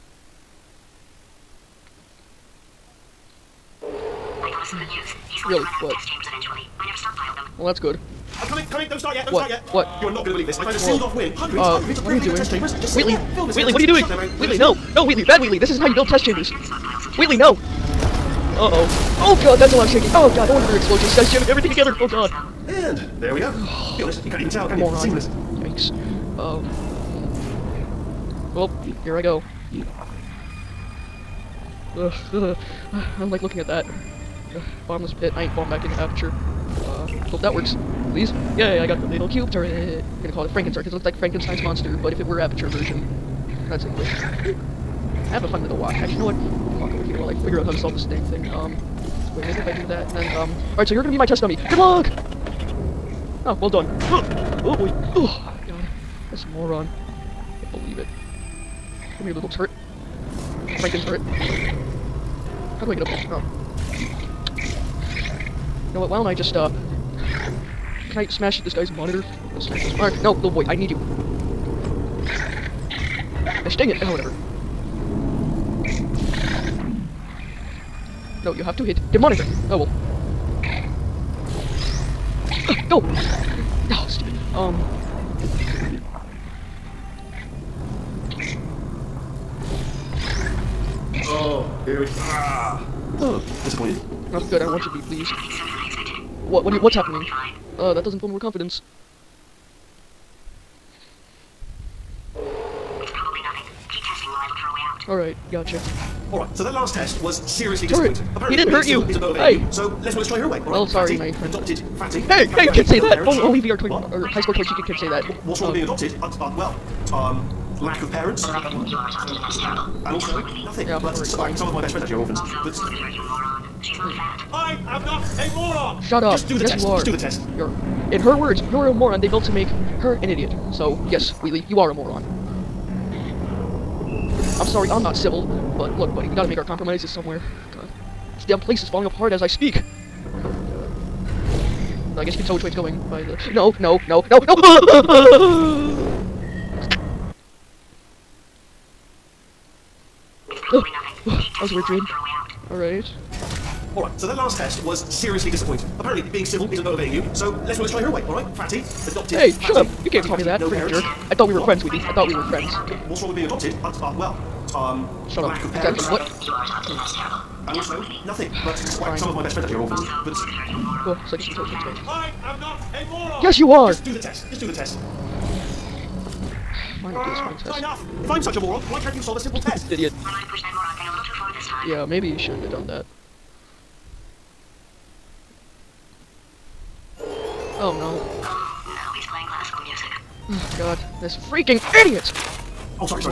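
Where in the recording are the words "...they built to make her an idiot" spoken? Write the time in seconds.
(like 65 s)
129 s.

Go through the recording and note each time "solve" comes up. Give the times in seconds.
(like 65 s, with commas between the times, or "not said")
47 s, 179 s.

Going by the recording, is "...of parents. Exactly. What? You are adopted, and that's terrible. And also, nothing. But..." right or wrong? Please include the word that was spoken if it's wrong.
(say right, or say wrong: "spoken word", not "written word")
right.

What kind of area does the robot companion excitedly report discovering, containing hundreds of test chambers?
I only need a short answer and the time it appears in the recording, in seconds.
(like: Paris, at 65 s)
sealed-off wing, at 10 s.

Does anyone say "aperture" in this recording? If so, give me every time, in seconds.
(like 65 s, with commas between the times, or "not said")
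35 s, 42 s.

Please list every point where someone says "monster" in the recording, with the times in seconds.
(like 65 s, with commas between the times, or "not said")
41 s.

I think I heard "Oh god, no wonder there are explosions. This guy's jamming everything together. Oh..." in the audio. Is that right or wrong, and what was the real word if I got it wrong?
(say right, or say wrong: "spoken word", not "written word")
right.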